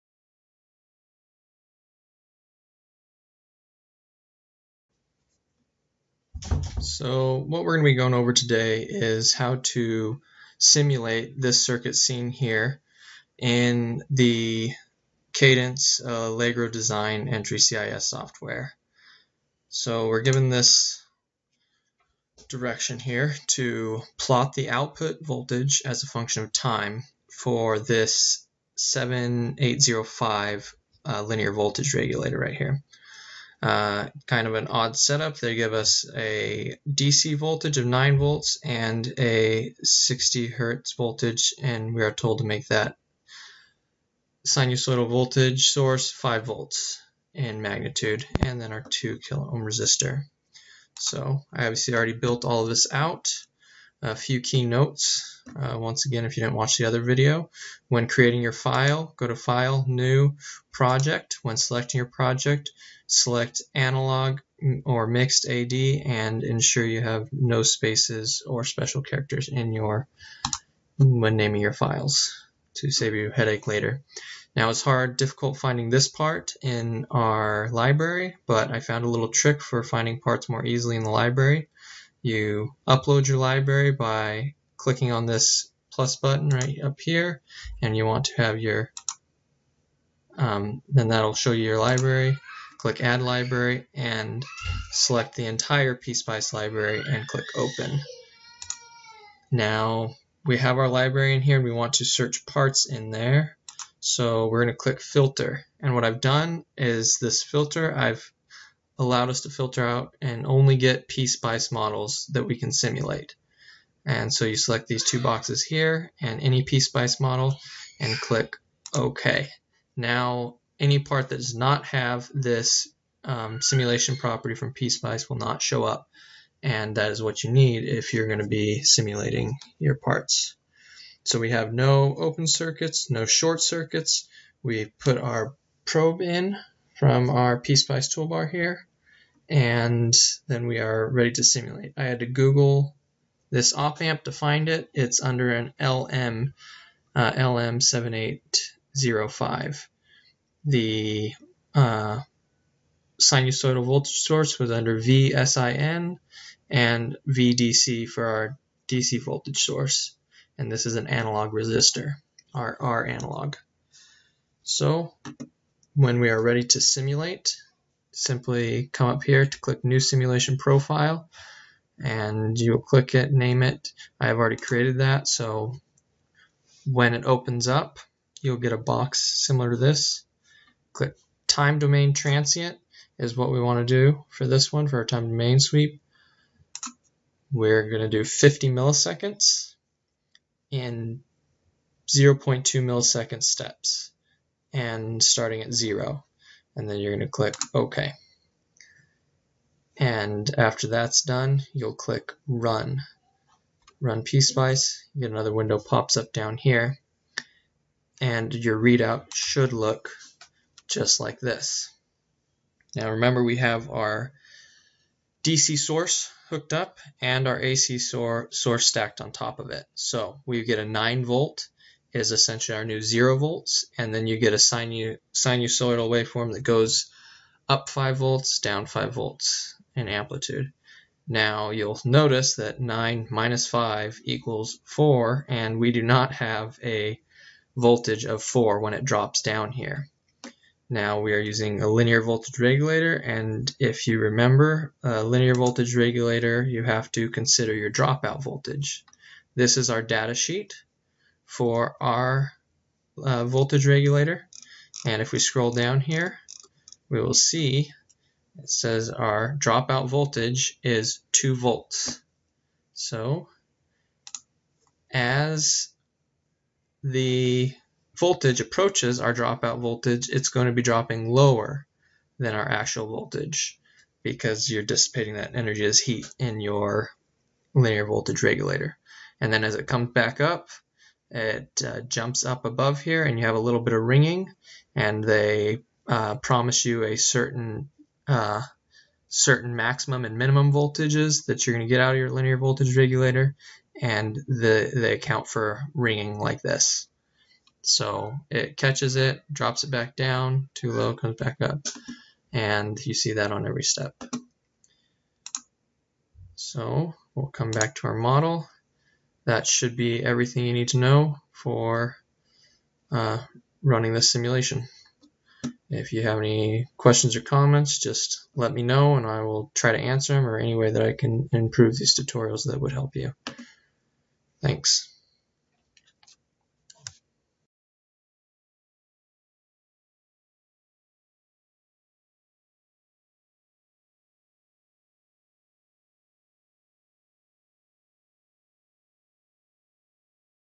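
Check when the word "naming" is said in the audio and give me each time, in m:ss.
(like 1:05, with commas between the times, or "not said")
1:11.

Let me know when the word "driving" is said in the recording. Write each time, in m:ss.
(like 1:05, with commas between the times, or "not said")
not said.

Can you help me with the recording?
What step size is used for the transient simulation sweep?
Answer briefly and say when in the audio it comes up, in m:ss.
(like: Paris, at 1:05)
0.2 millisecond, at 3:12.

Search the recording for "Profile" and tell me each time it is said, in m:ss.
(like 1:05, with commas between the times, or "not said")
2:50.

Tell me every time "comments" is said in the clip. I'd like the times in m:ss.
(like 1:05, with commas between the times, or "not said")
5:17.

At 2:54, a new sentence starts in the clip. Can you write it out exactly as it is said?
I have already created that, so when it opens up, you'll get a box similar to this.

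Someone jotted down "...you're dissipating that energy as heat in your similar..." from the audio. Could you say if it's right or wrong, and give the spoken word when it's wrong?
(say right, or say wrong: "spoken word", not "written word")
wrong: "linear", not "similar".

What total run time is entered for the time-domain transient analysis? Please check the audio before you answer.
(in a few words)
50 milliseconds.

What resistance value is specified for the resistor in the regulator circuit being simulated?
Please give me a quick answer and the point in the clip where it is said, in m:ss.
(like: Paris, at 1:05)
2 kilo ohm, at 0:48.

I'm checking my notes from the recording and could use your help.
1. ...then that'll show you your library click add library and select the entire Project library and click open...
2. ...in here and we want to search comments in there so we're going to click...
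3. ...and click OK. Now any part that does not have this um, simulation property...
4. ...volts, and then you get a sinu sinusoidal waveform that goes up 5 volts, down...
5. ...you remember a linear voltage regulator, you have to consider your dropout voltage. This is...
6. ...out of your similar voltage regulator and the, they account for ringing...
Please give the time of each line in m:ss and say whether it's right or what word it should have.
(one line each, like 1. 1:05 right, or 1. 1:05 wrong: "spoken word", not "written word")
1. 1:30 wrong: "PSpice", not "Project"
2. 1:41 wrong: "parts", not "comments"
3. 1:57 right
4. 3:43 right
5. 4:04 right
6. 4:52 wrong: "linear", not "similar".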